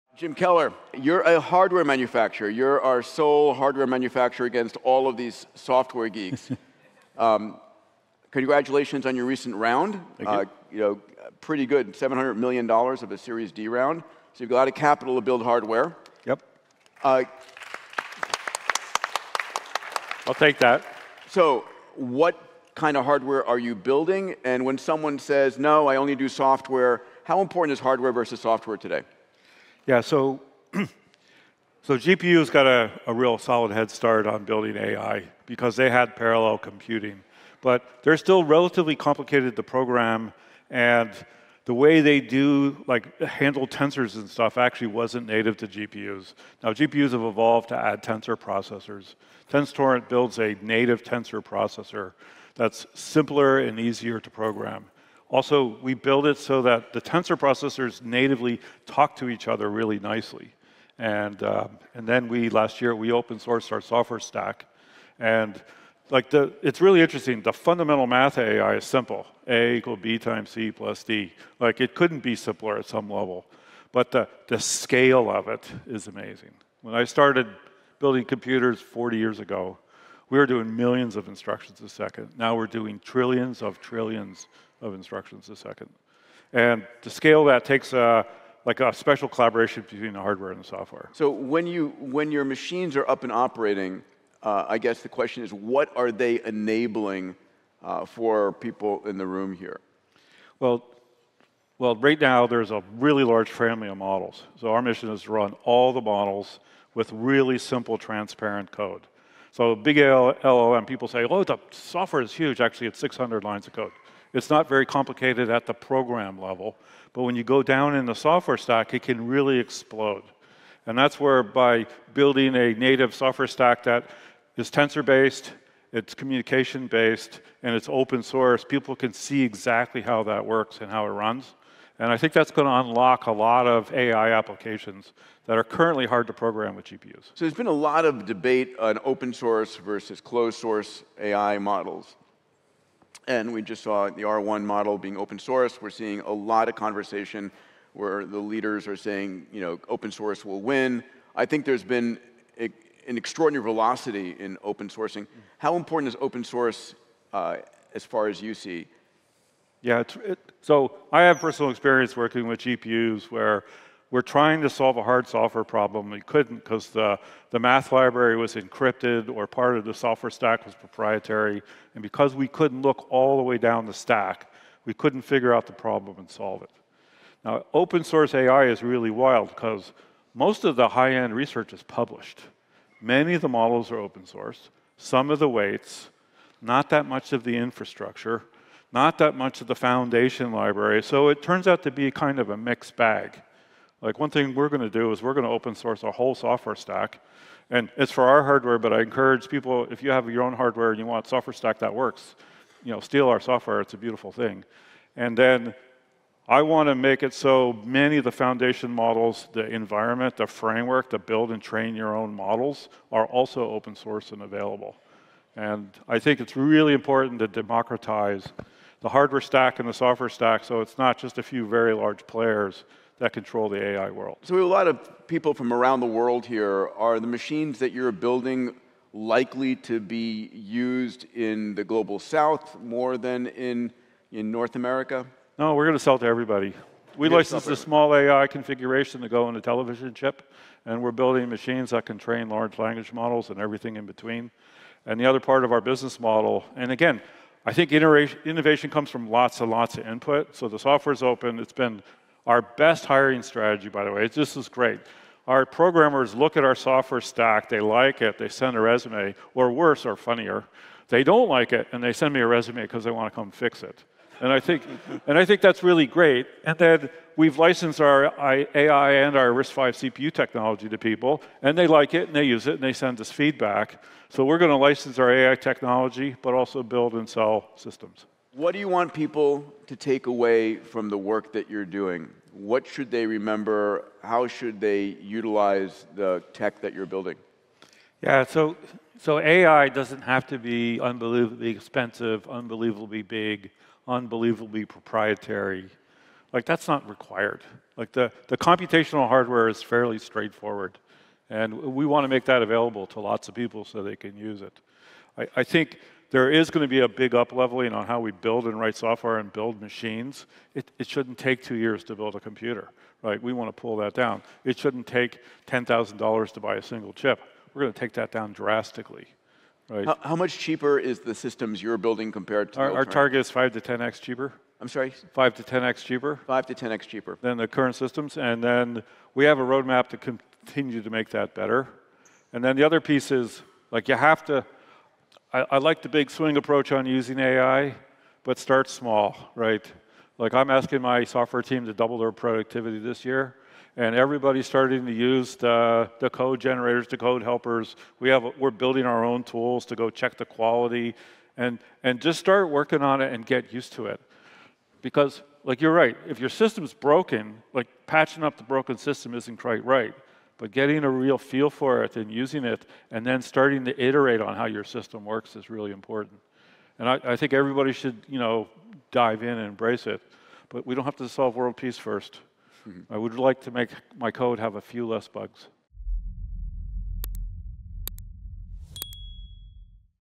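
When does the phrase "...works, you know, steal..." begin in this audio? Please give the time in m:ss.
3:21.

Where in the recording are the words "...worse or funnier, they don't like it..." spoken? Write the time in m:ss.
4:19.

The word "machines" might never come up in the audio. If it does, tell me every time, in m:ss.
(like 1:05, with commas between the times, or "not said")
1:32, 3:47, 4:01, 5:09.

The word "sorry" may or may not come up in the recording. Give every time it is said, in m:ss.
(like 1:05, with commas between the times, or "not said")
5:24.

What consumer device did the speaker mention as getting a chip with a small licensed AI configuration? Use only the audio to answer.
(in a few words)
Television.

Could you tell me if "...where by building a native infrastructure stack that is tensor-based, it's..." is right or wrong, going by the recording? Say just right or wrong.
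wrong.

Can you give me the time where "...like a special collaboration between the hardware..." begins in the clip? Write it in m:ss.
1:28.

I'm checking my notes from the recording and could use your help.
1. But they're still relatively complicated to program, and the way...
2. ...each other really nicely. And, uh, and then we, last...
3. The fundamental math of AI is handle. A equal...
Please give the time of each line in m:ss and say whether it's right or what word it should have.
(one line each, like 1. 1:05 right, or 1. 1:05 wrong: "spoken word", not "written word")
1. 0:37 right
2. 0:59 right
3. 1:07 wrong: "simple", not "handle".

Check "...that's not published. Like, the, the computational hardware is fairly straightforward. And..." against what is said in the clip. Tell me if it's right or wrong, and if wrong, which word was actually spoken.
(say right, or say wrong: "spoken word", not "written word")
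wrong: "required", not "published".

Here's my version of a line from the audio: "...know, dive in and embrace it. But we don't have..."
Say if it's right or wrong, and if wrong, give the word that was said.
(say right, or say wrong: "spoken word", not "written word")
right.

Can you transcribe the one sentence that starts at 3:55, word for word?
No, we're going to sell to everybody.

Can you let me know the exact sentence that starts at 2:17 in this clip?
So there's been a lot of debate on open source versus closed source AI models.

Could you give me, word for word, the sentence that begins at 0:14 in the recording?
So you've got a lot of capital to build hardware.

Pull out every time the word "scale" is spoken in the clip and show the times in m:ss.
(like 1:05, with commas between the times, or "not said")
1:14, 1:27.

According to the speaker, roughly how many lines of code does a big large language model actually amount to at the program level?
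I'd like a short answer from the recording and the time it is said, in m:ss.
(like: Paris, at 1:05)
600, at 1:52.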